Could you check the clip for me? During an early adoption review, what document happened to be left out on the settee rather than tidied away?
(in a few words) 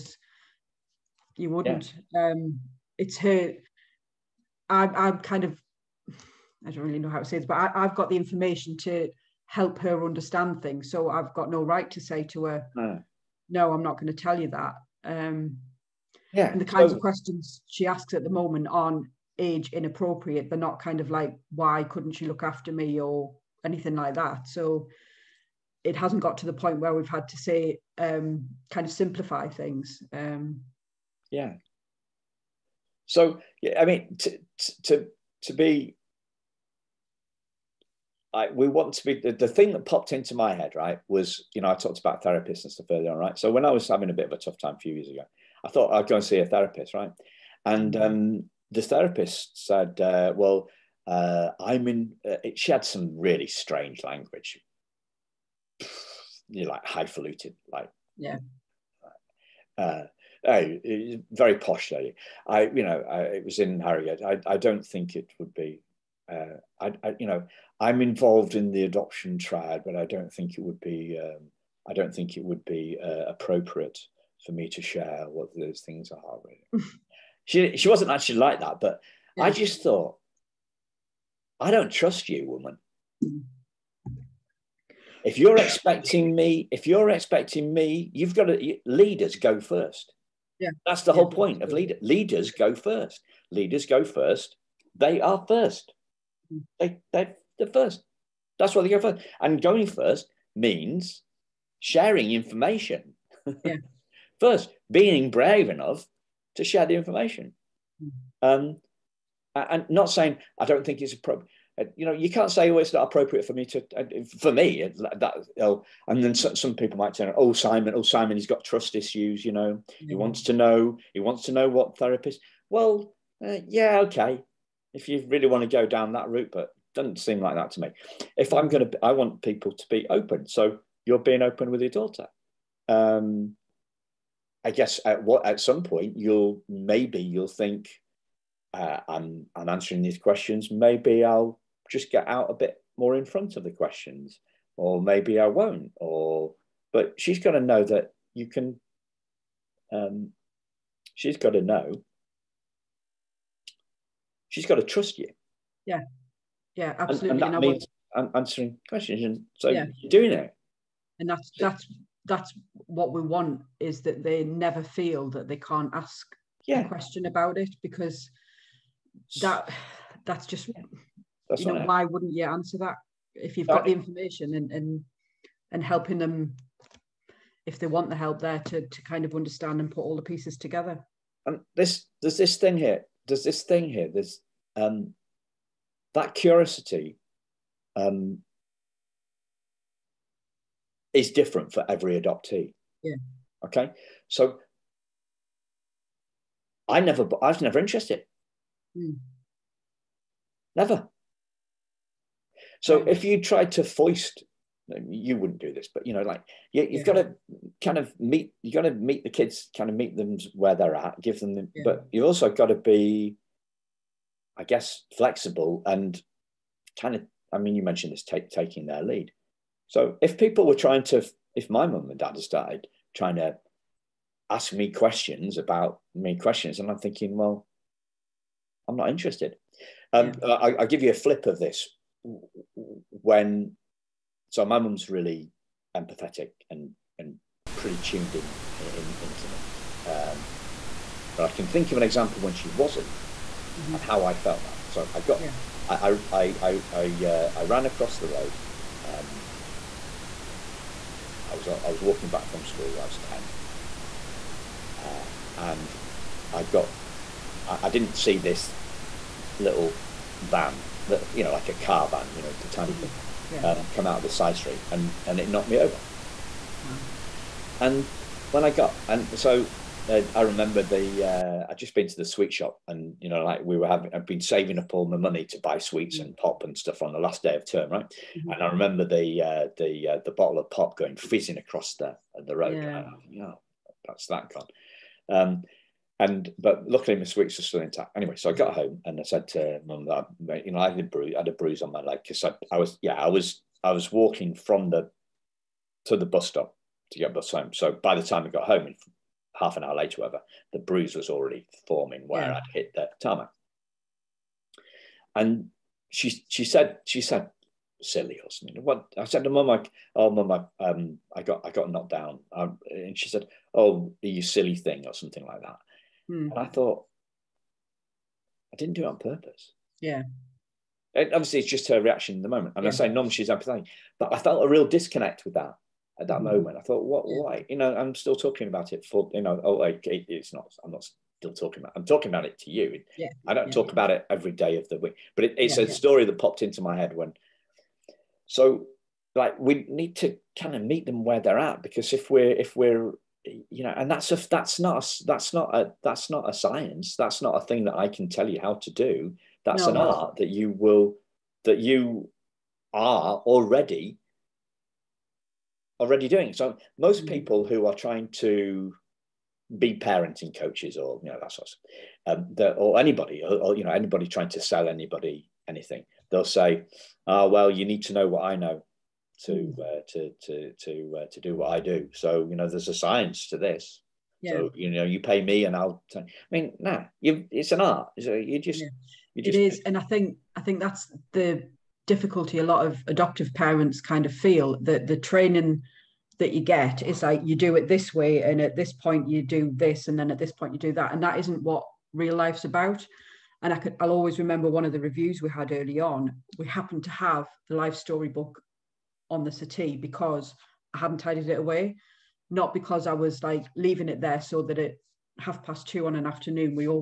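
life story book.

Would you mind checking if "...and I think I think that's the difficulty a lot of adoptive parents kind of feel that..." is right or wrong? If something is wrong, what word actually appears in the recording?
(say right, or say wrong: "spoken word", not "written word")
right.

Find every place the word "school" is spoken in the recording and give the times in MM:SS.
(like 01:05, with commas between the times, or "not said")
04:12.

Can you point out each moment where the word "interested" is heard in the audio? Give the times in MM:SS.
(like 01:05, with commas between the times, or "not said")
03:17, 03:49.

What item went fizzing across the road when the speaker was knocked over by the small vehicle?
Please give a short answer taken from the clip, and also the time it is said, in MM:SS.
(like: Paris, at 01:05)
bottle of pop, at 04:40.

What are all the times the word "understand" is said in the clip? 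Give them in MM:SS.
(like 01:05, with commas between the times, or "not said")
00:10, 02:59.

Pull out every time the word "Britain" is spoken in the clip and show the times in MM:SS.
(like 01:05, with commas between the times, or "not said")
not said.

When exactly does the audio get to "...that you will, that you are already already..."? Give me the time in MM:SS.
05:50.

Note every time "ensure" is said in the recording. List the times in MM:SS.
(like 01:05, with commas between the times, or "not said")
not said.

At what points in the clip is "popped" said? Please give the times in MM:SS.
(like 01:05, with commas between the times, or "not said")
00:39, 05:36.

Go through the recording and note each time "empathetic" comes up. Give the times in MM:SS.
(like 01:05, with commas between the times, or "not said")
03:55, 05:23.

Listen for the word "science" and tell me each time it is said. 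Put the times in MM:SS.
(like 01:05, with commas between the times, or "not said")
05:46, 06:12.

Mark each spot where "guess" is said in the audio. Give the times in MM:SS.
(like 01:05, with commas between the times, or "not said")
02:14, 03:34.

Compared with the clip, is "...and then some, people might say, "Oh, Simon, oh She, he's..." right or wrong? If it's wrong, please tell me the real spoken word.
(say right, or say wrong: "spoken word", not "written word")
wrong: "Simon", not "She".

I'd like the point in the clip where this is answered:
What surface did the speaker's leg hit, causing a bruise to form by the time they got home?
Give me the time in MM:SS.
05:03.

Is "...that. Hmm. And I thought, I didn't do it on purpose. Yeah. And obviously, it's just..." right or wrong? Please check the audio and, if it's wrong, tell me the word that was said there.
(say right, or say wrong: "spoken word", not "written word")
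right.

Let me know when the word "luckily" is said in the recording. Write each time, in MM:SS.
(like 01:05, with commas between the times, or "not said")
04:46.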